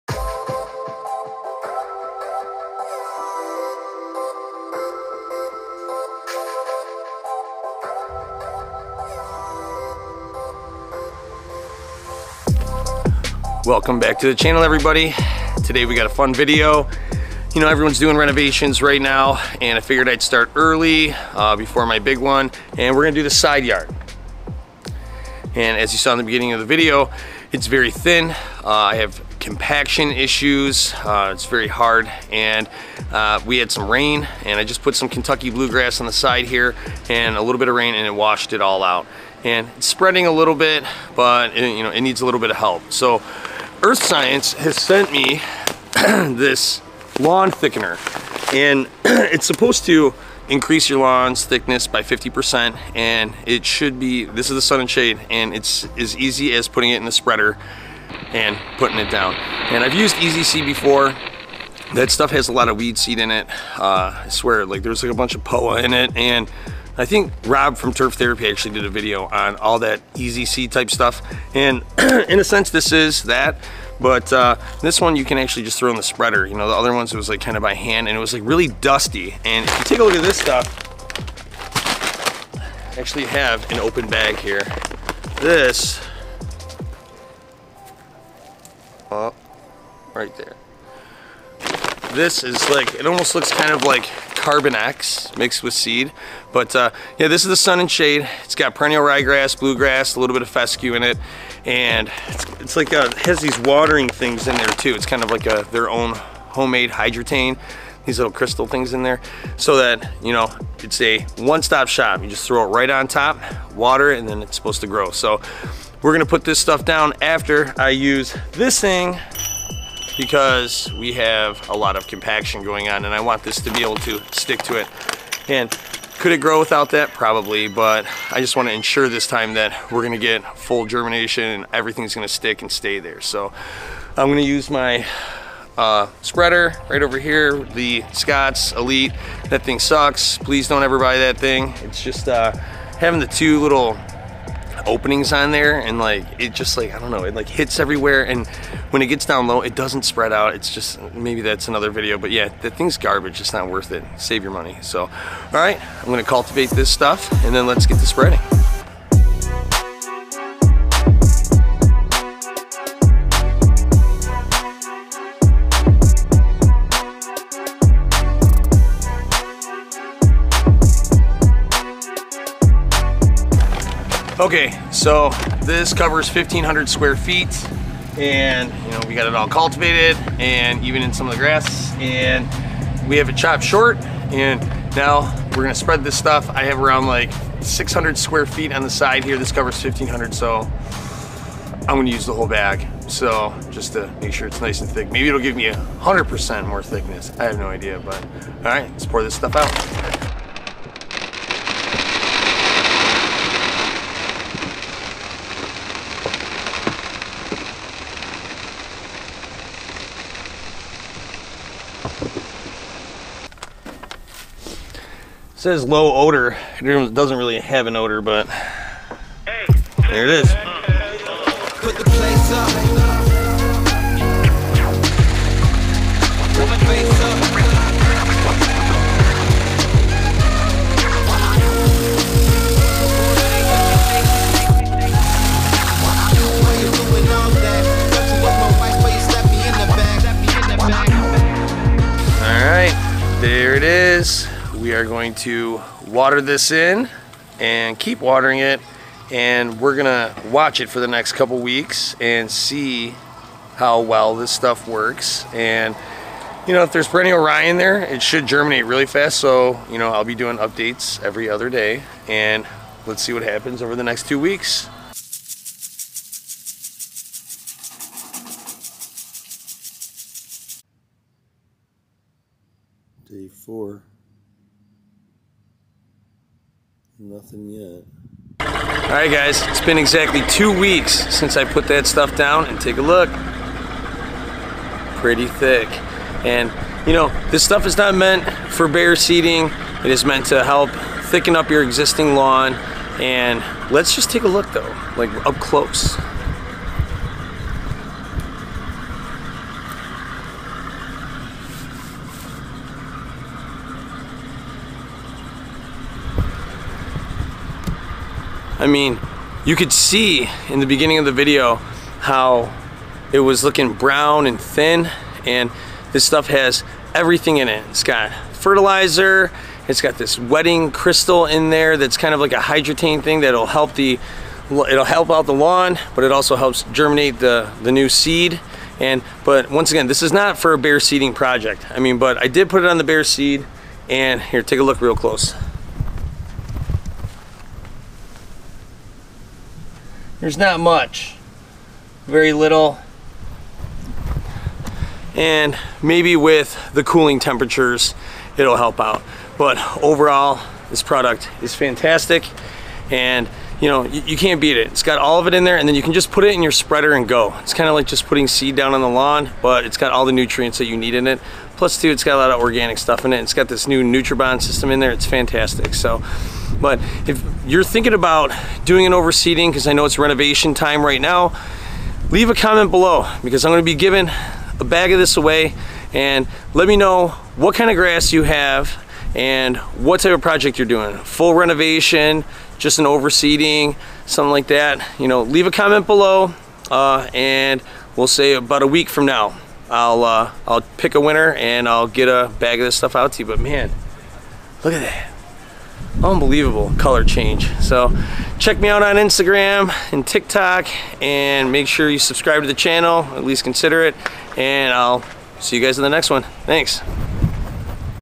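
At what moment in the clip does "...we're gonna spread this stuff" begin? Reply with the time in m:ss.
3:05.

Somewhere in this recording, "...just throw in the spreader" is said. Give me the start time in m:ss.
1:15.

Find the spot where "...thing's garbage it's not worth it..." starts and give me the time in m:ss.
2:32.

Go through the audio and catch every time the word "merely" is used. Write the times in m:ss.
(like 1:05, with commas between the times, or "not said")
not said.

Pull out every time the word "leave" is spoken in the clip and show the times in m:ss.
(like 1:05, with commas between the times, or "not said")
6:12, 6:25.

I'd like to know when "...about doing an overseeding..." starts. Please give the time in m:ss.
6:08.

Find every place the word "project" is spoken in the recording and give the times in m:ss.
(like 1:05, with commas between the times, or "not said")
5:31, 6:20.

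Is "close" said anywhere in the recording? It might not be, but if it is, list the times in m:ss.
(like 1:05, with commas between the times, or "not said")
4:55, 5:35.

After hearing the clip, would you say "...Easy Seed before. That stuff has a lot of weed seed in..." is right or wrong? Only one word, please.
right.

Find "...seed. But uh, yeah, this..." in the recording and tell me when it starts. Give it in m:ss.
1:35.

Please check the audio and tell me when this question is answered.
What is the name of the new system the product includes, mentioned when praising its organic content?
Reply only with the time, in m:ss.
6:04.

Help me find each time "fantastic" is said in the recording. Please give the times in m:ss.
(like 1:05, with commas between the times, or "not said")
5:51, 6:05.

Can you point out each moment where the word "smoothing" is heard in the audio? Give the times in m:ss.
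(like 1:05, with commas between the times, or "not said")
not said.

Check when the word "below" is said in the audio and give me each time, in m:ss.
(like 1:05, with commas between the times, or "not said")
6:12, 6:26.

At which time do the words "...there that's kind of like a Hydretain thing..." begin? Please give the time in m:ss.
5:21.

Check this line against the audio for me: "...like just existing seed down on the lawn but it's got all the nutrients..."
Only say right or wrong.
wrong.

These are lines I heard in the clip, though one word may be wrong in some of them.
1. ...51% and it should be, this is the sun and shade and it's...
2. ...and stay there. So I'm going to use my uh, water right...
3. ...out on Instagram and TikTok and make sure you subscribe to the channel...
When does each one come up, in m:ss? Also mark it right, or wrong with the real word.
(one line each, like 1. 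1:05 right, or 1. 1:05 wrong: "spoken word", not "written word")
1. 0:52 wrong: "50", not "51"
2. 2:12 wrong: "spreader", not "water"
3. 6:38 right.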